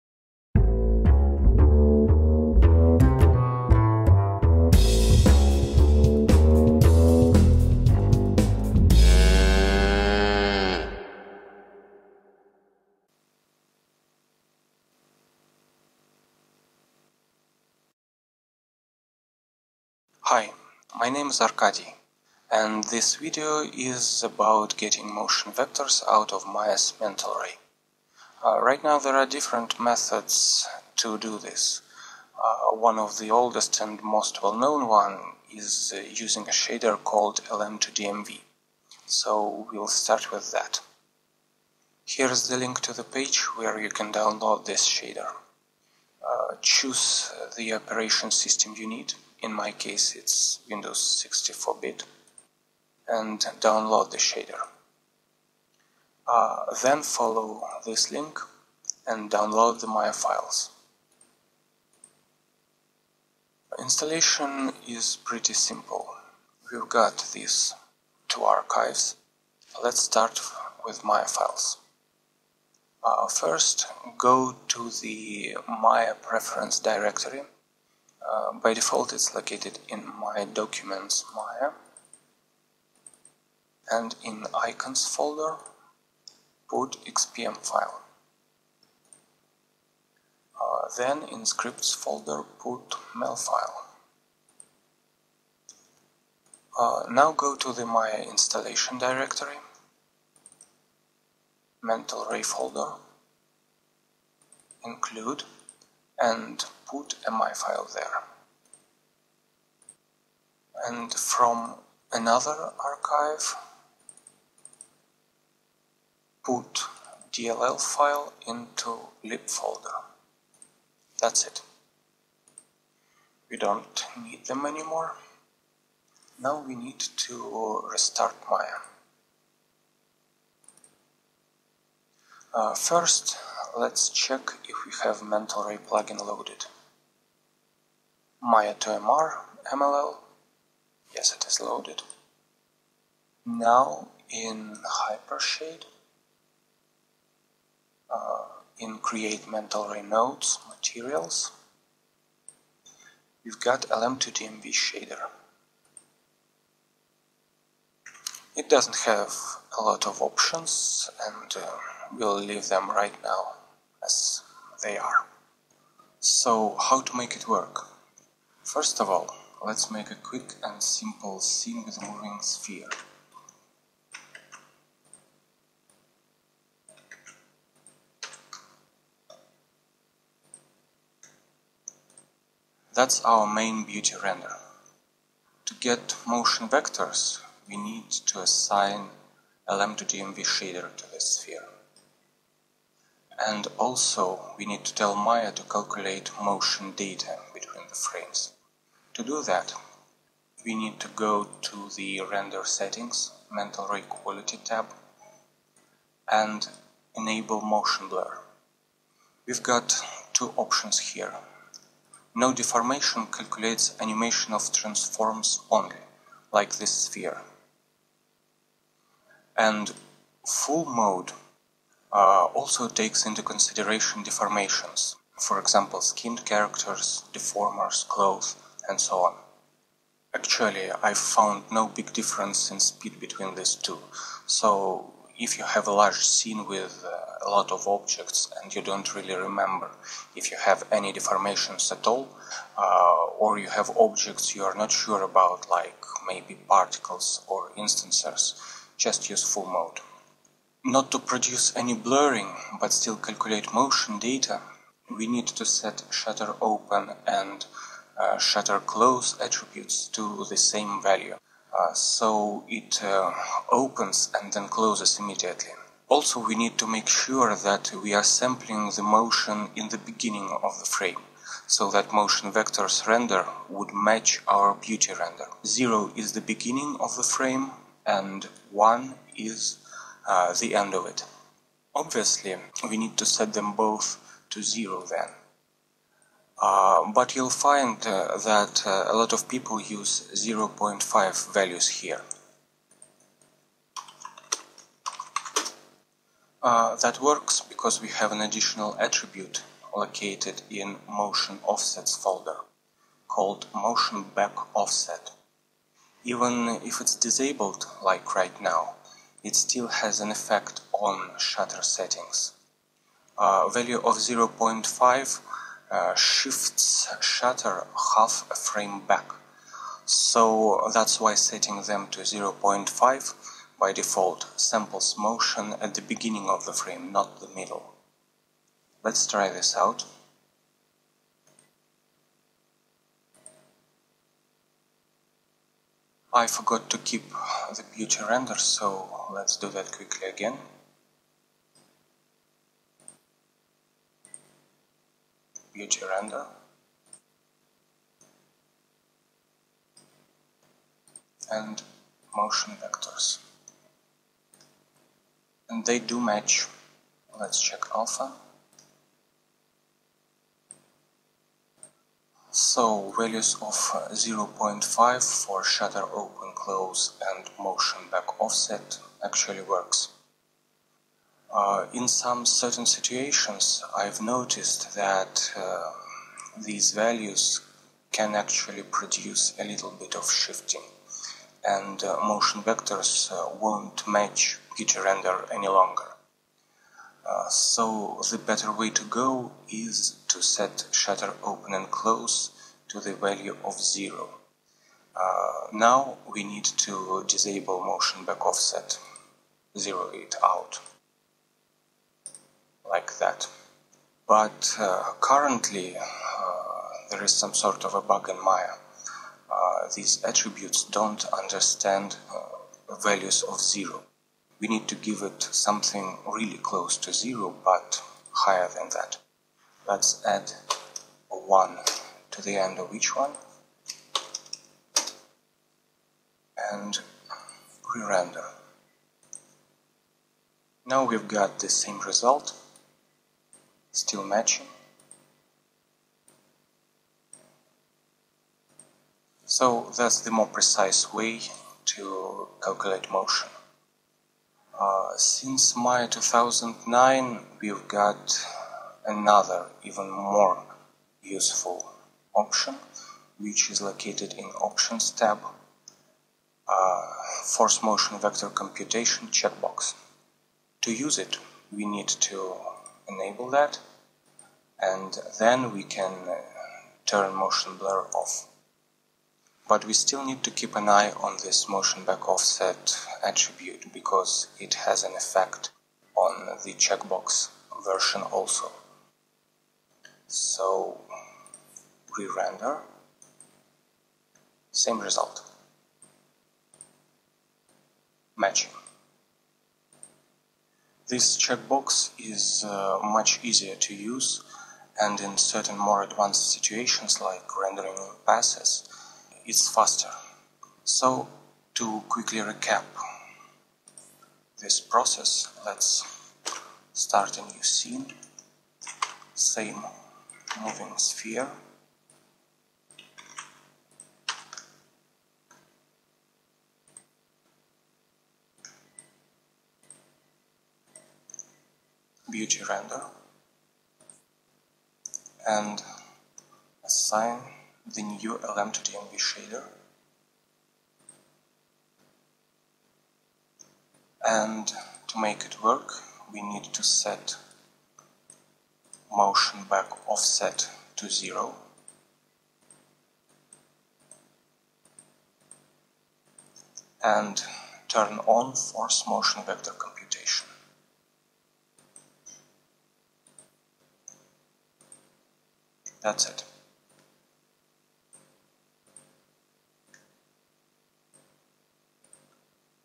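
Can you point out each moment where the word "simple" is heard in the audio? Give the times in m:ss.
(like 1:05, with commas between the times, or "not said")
1:05, 2:50.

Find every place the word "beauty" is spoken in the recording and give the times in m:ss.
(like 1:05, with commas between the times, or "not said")
3:03, 4:34, 5:37, 5:45, 6:24, 8:42.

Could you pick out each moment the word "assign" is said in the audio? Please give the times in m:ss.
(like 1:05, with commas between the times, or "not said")
3:08, 8:46.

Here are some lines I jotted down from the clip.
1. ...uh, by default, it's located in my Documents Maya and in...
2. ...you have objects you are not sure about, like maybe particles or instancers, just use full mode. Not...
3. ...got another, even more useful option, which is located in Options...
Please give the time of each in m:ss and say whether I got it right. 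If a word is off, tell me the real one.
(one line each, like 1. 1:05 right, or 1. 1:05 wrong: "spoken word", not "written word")
1. 1:18 right
2. 4:03 right
3. 7:27 right.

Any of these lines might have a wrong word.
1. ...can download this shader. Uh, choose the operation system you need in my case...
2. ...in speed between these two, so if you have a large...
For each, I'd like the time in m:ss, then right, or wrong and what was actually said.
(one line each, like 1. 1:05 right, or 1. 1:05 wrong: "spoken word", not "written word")
1. 0:43 right
2. 3:52 right.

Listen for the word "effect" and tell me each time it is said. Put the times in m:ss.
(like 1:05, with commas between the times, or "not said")
5:10, 7:55.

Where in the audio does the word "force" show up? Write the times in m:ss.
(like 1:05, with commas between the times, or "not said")
7:37, 9:08.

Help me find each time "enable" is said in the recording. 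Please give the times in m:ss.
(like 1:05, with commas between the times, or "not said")
3:27, 7:43.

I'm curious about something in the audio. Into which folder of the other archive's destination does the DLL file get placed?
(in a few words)
lib.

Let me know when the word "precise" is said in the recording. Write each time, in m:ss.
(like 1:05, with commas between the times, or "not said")
7:20.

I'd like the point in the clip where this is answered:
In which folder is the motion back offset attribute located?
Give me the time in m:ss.
5:01.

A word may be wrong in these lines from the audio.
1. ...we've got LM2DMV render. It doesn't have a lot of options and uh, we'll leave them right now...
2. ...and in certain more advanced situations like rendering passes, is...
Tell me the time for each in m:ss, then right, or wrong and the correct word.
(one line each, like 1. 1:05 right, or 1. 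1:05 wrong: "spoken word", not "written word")
1. 2:33 wrong: "shader", not "render"
2. 8:14 right.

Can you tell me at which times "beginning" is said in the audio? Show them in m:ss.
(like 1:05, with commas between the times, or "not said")
4:29, 4:36, 5:26.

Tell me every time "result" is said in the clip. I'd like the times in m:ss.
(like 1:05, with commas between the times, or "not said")
7:12, 8:04.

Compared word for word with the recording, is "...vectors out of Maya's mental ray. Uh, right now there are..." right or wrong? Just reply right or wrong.
right.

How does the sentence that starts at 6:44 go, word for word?
But uh, currently uh, there is some sort of a bug in Maya.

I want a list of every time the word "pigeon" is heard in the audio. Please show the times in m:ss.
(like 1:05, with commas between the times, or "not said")
not said.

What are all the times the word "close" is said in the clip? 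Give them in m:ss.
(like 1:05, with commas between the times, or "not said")
4:18, 4:24, 6:06, 6:31, 6:56.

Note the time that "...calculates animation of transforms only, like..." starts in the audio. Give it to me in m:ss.
3:33.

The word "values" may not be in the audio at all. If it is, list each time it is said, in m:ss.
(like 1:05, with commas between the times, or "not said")
4:20, 4:51, 5:13, 6:03, 6:16, 6:33, 6:53.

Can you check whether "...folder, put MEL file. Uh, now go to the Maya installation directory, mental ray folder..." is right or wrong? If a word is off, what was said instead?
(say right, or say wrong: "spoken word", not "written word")
right.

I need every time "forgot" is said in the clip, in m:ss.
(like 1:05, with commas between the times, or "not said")
5:36.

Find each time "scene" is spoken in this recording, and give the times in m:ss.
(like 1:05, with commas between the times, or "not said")
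2:51, 3:56, 8:27.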